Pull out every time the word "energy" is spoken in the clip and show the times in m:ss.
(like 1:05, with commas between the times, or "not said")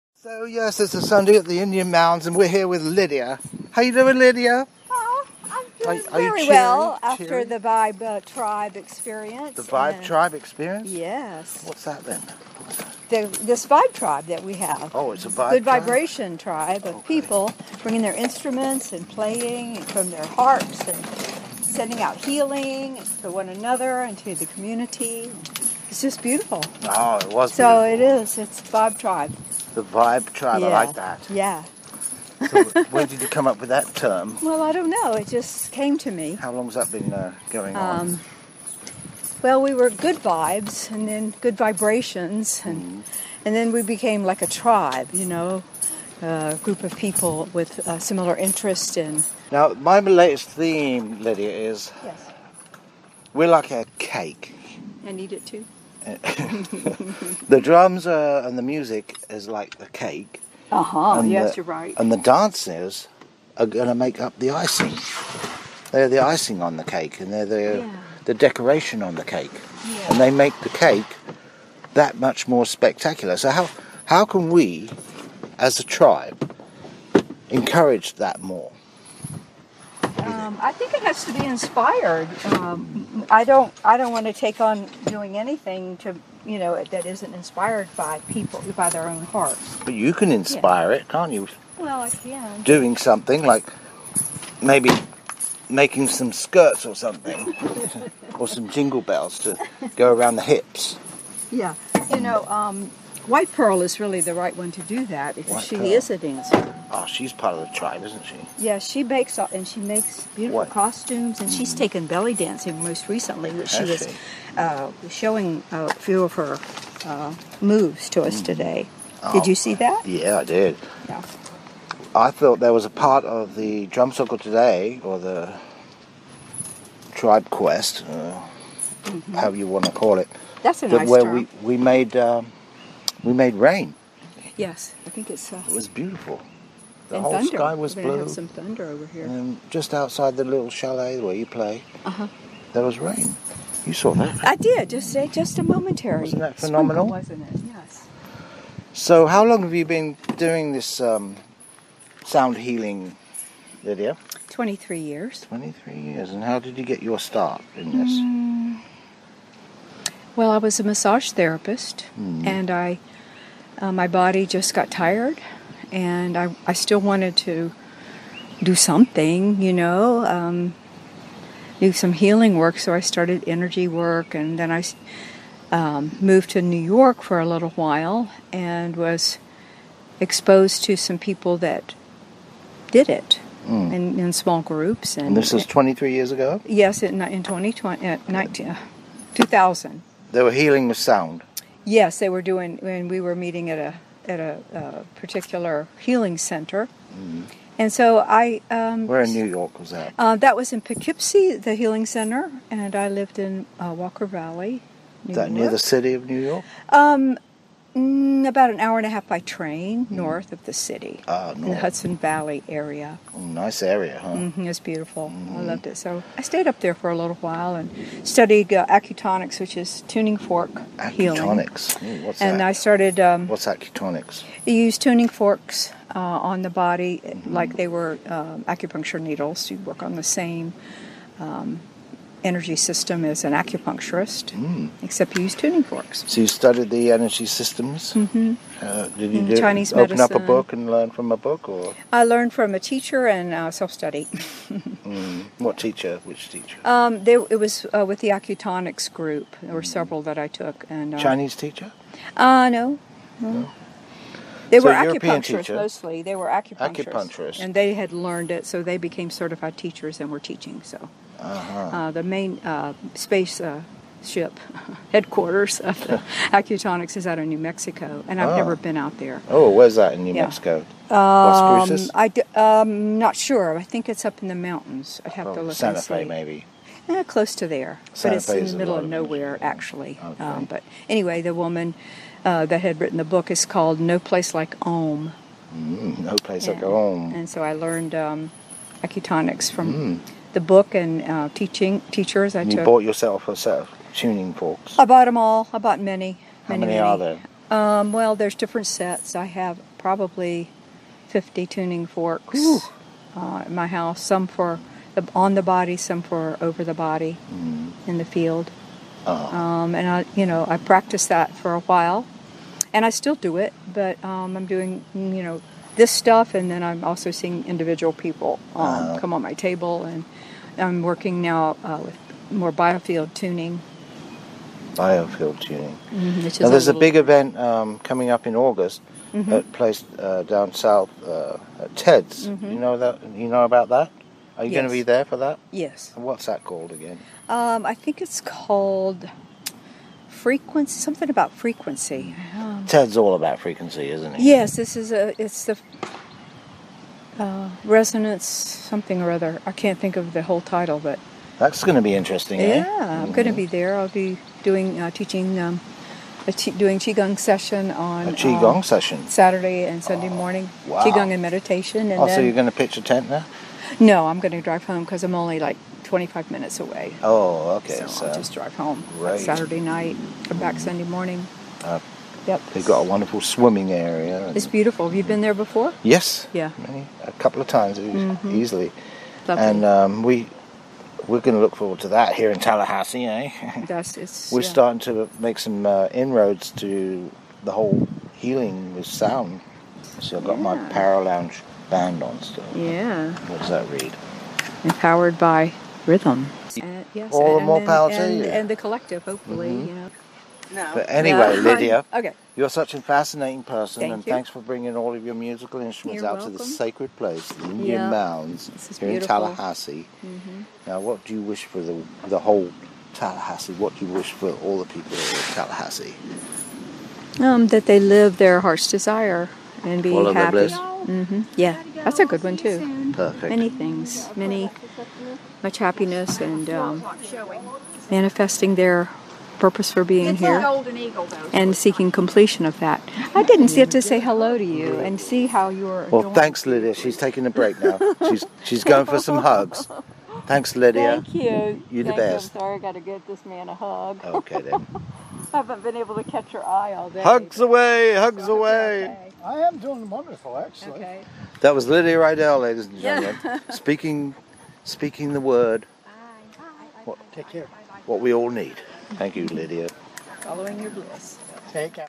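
2:53, 3:52, 3:57.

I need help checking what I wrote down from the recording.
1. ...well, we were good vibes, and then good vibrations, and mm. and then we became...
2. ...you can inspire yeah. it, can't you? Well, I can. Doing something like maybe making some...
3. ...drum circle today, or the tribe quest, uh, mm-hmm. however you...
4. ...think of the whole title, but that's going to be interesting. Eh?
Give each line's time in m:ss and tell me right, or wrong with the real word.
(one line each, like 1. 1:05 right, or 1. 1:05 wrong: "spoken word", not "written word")
1. 0:39 right
2. 1:29 right
3. 2:03 right
4. 5:49 right.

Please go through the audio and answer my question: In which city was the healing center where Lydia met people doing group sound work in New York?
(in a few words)
Poughkeepsie.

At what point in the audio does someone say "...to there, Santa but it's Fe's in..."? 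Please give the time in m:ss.
4:37.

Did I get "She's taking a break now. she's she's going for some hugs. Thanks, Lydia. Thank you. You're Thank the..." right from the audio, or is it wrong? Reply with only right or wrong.
right.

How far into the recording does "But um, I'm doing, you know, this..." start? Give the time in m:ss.
5:13.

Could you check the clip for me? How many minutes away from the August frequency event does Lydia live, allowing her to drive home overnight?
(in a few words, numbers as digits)
25.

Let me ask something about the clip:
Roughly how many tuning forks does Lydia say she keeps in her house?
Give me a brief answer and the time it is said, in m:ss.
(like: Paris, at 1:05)
50, at 5:01.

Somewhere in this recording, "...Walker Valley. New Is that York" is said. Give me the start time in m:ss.
3:23.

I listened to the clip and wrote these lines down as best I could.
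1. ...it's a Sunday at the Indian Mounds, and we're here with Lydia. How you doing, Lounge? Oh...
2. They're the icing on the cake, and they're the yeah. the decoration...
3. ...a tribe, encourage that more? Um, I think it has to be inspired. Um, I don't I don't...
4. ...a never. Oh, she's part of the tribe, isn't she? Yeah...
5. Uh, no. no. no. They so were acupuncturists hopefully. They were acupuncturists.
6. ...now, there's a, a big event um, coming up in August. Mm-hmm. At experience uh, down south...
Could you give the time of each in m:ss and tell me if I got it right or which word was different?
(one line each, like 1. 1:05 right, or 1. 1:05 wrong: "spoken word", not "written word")
1. 0:00 wrong: "Lydia", not "Lounge"
2. 1:05 right
3. 1:15 right
4. 1:46 wrong: "dancer", not "never"
5. 4:12 wrong: "mostly", not "hopefully"
6. 5:26 wrong: "place", not "experience".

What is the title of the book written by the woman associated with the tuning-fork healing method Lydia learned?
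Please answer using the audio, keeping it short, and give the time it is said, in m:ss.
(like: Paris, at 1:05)
No Place Like Om, at 4:43.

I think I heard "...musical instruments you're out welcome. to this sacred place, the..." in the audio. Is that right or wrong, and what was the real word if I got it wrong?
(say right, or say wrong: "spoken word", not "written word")
right.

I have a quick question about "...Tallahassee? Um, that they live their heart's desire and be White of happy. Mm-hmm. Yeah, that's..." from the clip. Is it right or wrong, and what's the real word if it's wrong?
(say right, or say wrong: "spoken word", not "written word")
wrong: "All", not "White".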